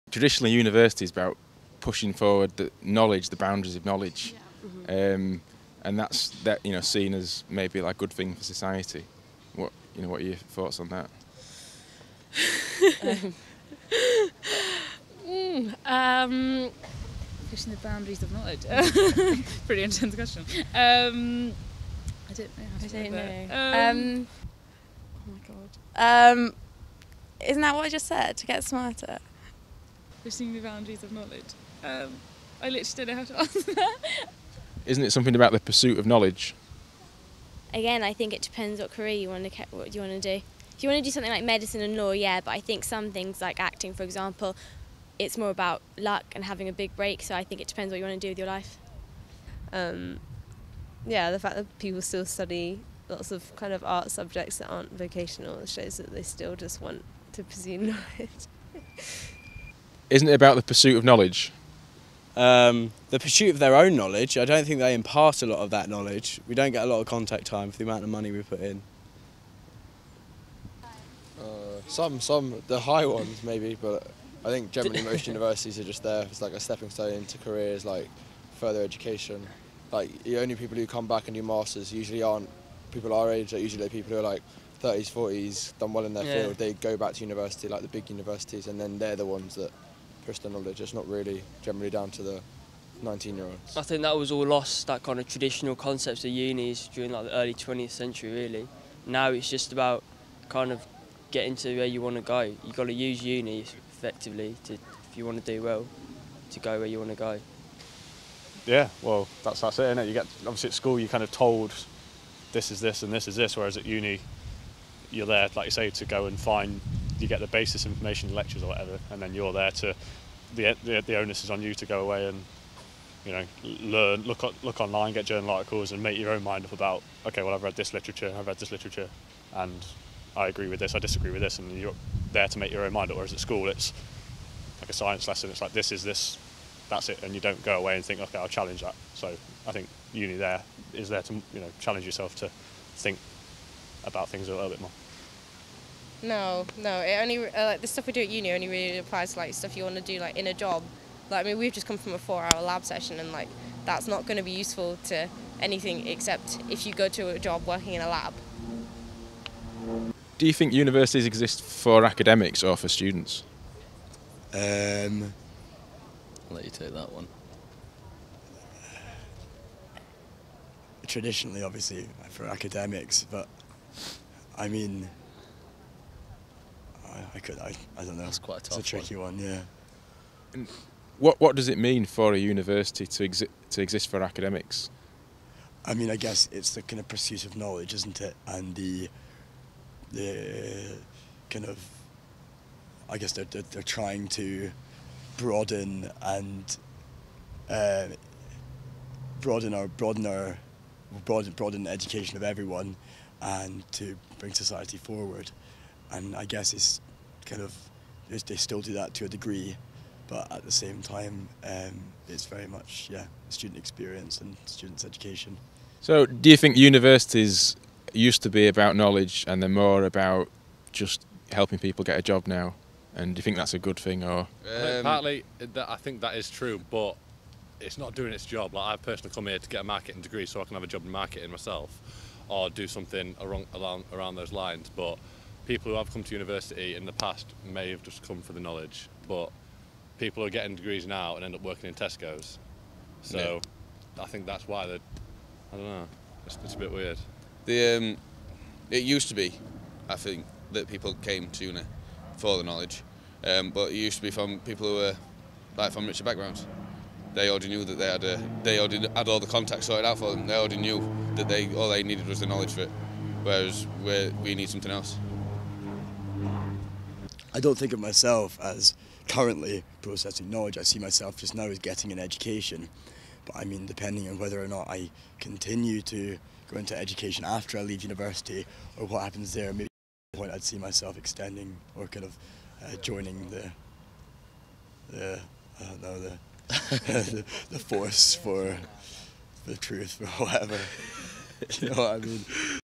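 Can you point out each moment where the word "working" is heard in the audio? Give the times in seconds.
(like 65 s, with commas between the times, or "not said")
157 s, 241 s.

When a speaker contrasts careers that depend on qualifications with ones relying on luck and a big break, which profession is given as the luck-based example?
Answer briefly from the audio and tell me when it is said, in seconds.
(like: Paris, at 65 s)
acting, at 43 s.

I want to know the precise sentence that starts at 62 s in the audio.
Um, the pursuit of their own knowledge.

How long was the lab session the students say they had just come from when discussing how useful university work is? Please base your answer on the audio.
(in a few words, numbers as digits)
4 hours.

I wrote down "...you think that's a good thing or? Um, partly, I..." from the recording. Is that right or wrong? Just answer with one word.
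right.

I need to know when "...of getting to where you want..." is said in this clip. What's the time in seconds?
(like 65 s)
100 s.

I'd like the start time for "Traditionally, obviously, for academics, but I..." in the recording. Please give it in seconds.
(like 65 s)
171 s.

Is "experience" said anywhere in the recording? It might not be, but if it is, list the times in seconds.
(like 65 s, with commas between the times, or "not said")
213 s.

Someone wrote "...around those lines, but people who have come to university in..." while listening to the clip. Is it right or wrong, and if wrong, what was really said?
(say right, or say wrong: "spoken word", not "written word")
right.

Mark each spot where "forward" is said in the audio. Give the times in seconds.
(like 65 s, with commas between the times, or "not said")
2 s, 204 s.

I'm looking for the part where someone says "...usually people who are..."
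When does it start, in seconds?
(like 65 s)
83 s.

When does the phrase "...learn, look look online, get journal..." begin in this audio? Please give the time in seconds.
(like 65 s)
123 s.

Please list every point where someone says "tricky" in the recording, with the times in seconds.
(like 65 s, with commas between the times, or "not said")
178 s.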